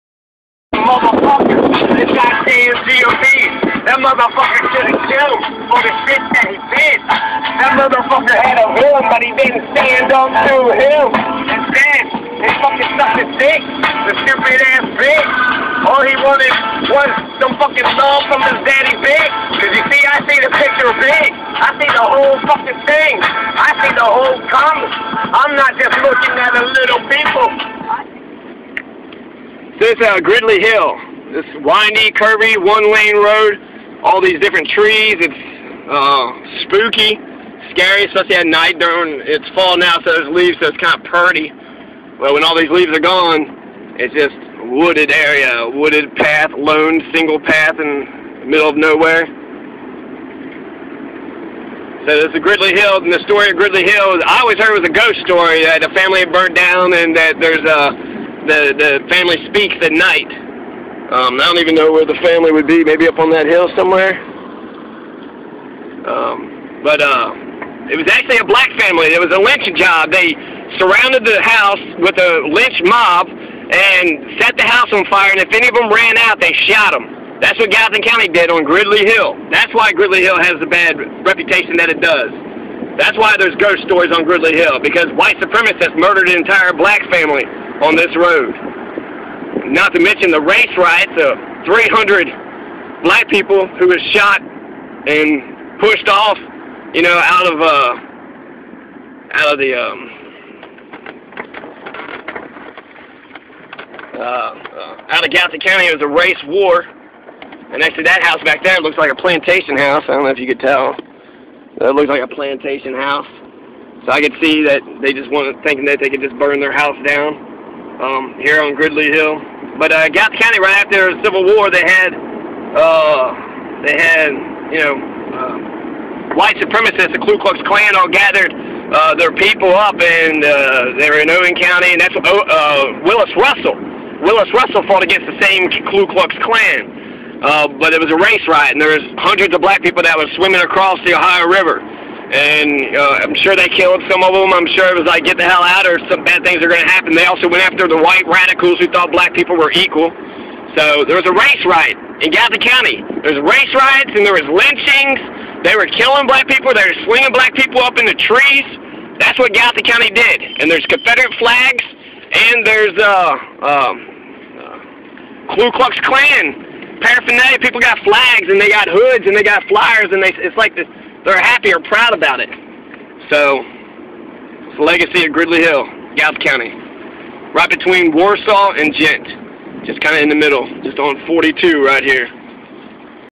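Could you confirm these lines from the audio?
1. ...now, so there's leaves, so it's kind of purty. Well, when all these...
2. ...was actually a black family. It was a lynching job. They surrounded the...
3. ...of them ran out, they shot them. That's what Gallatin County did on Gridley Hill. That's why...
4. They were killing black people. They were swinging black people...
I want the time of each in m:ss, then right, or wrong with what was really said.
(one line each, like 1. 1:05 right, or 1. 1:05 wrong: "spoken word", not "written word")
1. 0:39 right
2. 1:07 right
3. 1:15 right
4. 2:35 right.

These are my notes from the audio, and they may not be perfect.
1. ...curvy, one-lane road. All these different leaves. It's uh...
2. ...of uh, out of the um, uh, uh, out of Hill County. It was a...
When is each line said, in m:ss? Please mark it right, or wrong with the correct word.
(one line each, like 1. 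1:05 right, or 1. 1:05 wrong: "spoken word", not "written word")
1. 0:32 wrong: "trees", not "leaves"
2. 1:37 wrong: "Gallatin", not "Hill".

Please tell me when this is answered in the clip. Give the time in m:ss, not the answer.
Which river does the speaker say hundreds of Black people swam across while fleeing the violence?
2:21.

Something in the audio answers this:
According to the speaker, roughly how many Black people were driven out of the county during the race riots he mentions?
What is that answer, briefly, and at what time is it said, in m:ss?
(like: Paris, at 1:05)
300, at 1:31.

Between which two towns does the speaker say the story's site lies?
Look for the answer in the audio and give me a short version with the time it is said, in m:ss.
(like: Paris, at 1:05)
Warsaw and Ghent, at 2:58.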